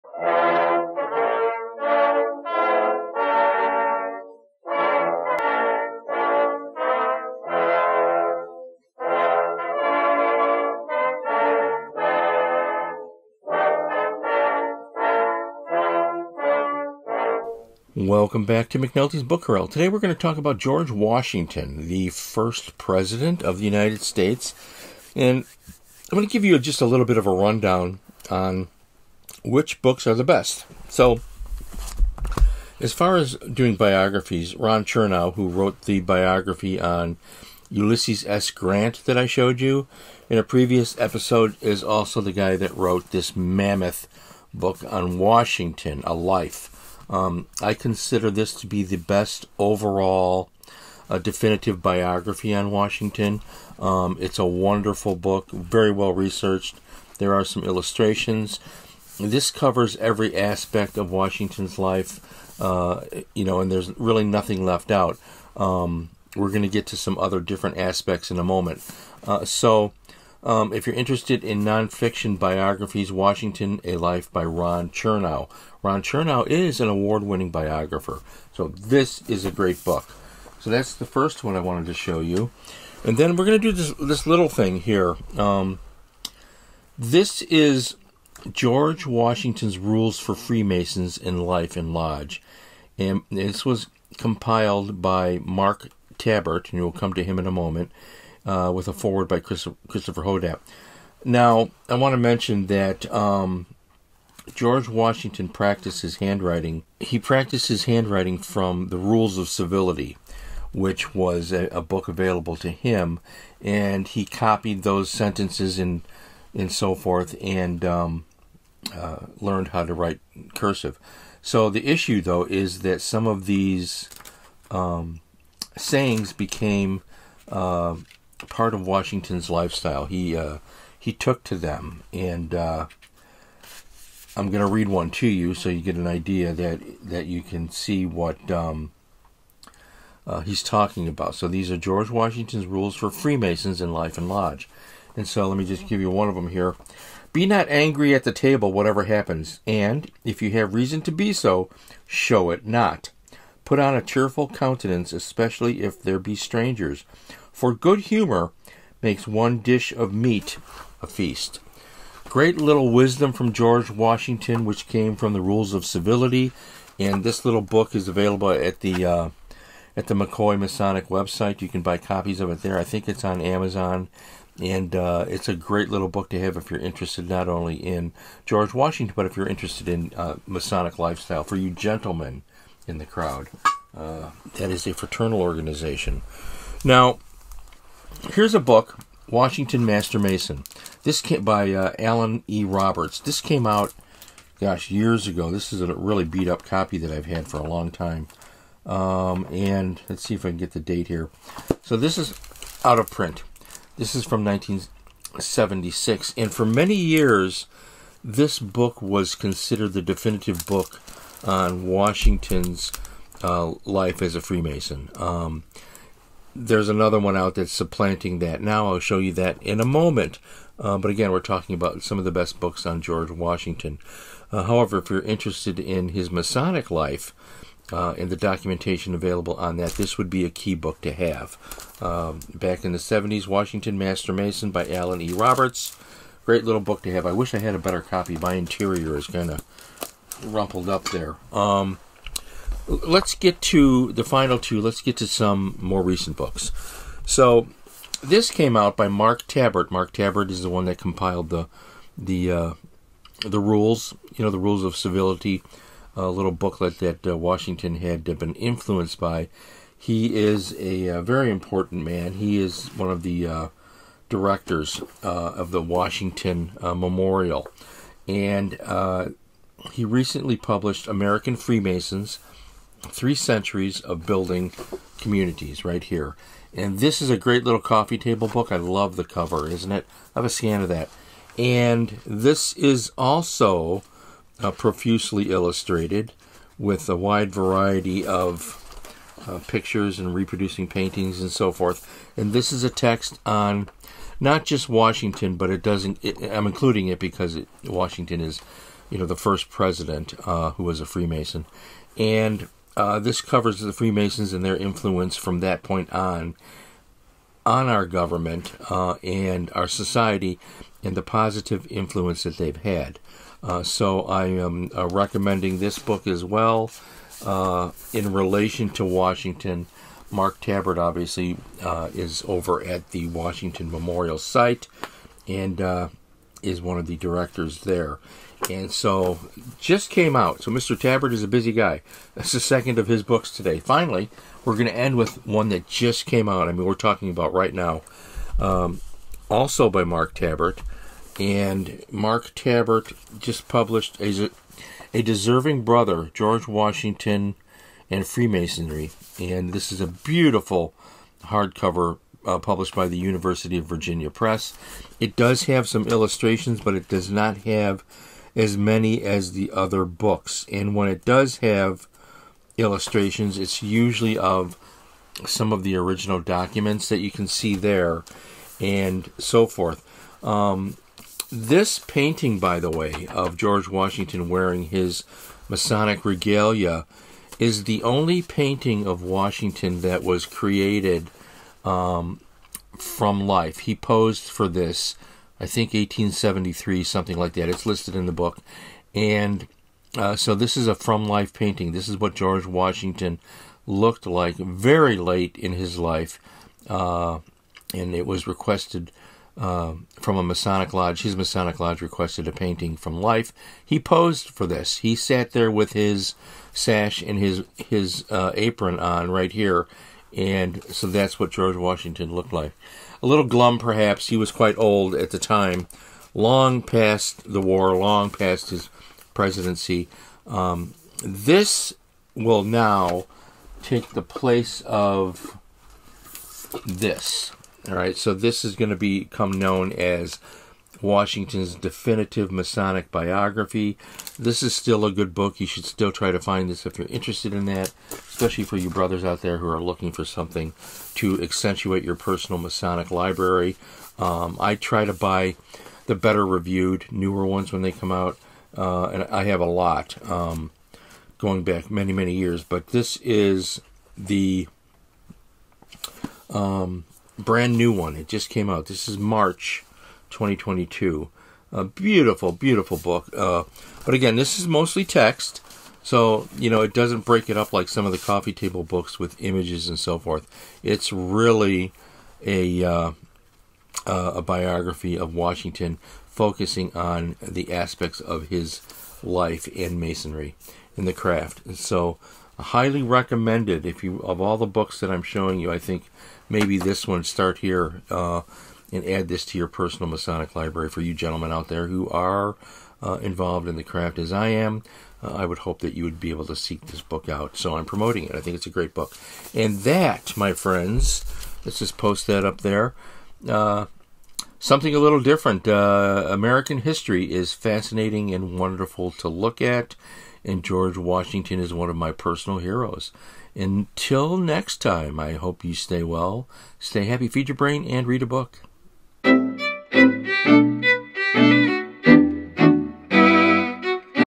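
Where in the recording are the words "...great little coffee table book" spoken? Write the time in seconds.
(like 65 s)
277 s.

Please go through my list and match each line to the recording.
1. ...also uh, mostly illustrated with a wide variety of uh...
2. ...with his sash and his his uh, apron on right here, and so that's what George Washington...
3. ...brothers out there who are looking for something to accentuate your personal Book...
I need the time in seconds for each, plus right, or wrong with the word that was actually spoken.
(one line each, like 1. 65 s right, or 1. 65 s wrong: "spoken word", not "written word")
1. 283 s wrong: "profusely", not "mostly"
2. 405 s right
3. 438 s wrong: "Masonic", not "Book".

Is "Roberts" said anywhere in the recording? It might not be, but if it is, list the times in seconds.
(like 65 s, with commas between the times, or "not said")
192 s, 235 s.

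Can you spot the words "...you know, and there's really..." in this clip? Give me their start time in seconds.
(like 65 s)
63 s.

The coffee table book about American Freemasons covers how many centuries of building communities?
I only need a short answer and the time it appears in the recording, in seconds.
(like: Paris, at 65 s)
3, at 273 s.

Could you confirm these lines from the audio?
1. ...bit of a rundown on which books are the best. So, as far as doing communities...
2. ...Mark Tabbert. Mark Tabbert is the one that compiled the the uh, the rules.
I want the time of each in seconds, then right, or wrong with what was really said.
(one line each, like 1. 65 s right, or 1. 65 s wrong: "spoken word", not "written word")
1. 27 s wrong: "biographies", not "communities"
2. 249 s right.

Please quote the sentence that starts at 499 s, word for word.
And that, my friends, let's just post that up there.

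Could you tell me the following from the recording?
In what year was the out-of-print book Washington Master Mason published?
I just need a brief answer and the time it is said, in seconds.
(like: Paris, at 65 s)
1976, at 204 s.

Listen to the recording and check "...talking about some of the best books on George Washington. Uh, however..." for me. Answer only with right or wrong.
right.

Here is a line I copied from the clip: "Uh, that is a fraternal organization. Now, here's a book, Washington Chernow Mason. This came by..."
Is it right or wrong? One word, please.
wrong.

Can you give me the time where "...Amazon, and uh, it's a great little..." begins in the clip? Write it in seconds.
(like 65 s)
173 s.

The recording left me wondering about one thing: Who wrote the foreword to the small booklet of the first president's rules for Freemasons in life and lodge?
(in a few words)
Christopher Hodapp.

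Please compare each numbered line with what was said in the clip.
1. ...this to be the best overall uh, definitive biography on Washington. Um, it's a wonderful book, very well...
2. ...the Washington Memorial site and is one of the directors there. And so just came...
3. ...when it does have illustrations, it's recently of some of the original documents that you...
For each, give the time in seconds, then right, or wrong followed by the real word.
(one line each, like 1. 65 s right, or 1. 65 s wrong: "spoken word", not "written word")
1. 48 s right
2. 323 s right
3. 360 s wrong: "usually", not "recently".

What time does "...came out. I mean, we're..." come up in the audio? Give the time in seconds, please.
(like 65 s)
336 s.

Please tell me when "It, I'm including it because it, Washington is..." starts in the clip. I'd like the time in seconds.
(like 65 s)
296 s.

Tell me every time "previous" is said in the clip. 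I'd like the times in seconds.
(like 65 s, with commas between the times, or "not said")
40 s.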